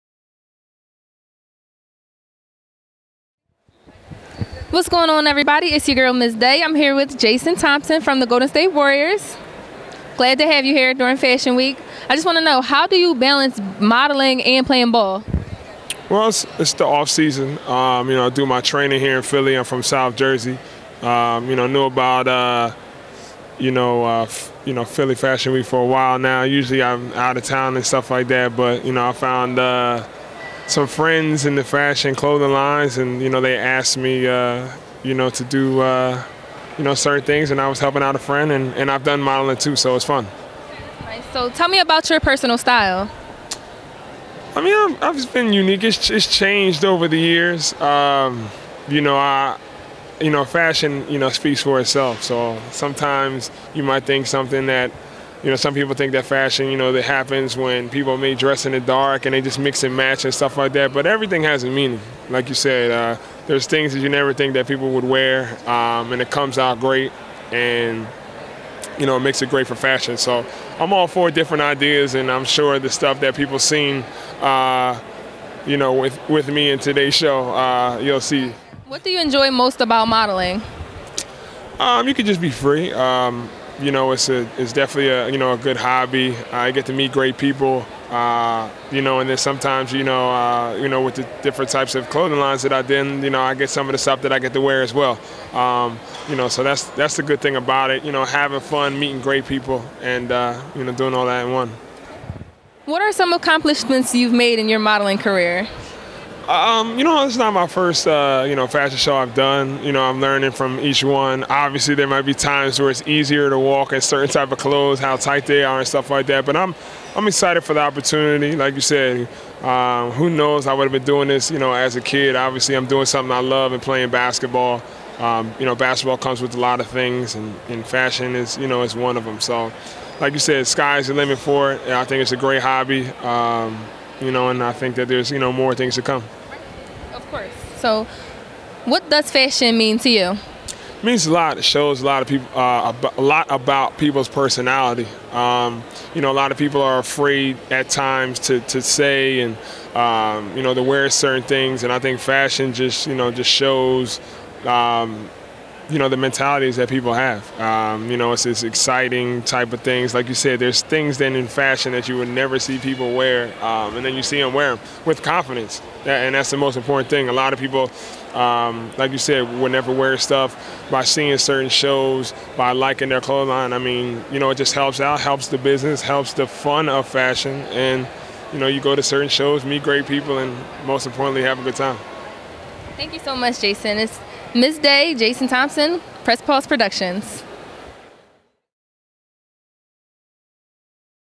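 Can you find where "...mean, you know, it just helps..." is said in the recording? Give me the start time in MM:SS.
02:53.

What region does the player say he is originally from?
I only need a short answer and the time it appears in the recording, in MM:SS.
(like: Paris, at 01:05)
South Jersey, at 00:19.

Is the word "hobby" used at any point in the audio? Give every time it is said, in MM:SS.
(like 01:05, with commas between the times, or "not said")
01:25, 02:12.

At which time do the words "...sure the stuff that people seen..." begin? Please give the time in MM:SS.
01:12.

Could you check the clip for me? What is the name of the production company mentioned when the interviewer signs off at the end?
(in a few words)
Press Pause Productions.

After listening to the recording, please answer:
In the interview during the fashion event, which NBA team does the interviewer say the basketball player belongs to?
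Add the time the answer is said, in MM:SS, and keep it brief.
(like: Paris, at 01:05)
Golden State Warriors, at 00:08.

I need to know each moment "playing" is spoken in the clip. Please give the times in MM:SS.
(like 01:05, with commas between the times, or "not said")
00:14, 02:03.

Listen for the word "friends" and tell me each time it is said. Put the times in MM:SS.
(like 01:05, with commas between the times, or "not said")
00:30, 00:38.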